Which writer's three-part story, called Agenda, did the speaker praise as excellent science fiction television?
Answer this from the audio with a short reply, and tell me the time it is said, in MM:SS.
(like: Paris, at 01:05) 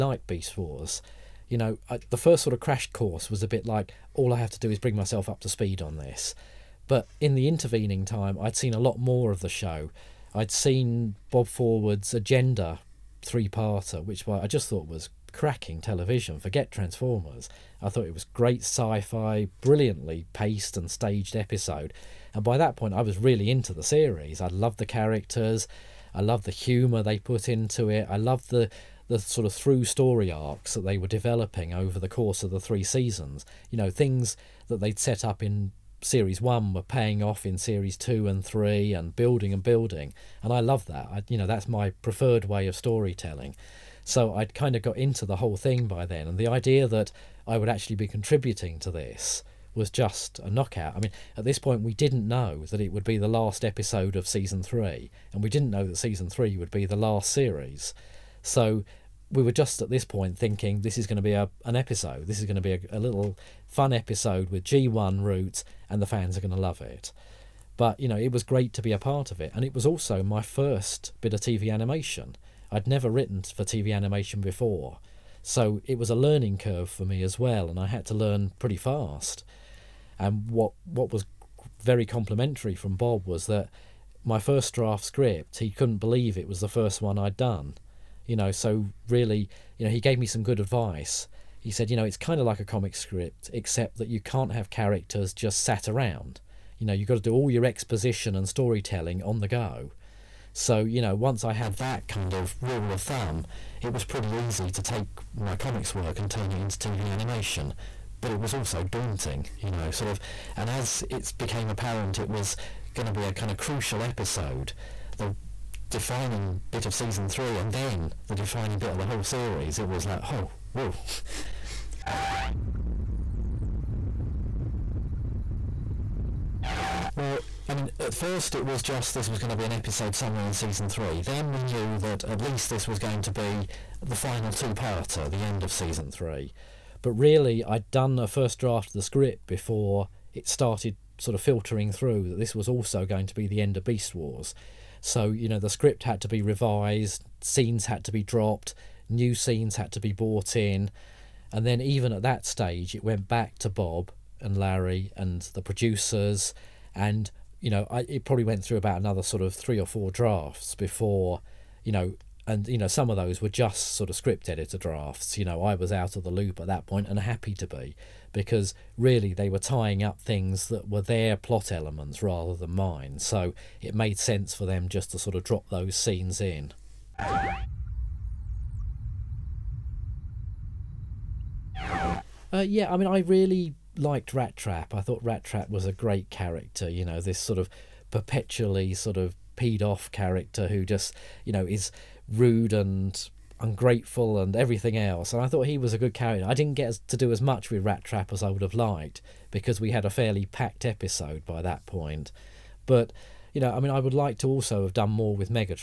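Bob Forward, at 00:11.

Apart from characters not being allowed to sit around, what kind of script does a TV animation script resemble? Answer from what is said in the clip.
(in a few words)
A comic script.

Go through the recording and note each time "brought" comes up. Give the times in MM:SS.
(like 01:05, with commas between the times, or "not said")
02:30.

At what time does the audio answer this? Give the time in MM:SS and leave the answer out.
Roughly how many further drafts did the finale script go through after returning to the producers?
02:39.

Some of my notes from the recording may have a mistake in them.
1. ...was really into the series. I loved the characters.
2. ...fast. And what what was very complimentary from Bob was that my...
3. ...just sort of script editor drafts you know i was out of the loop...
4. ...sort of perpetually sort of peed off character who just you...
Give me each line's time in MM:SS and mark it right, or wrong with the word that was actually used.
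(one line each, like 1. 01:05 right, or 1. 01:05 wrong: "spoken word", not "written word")
1. 00:23 right
2. 01:18 right
3. 02:43 right
4. 03:07 right.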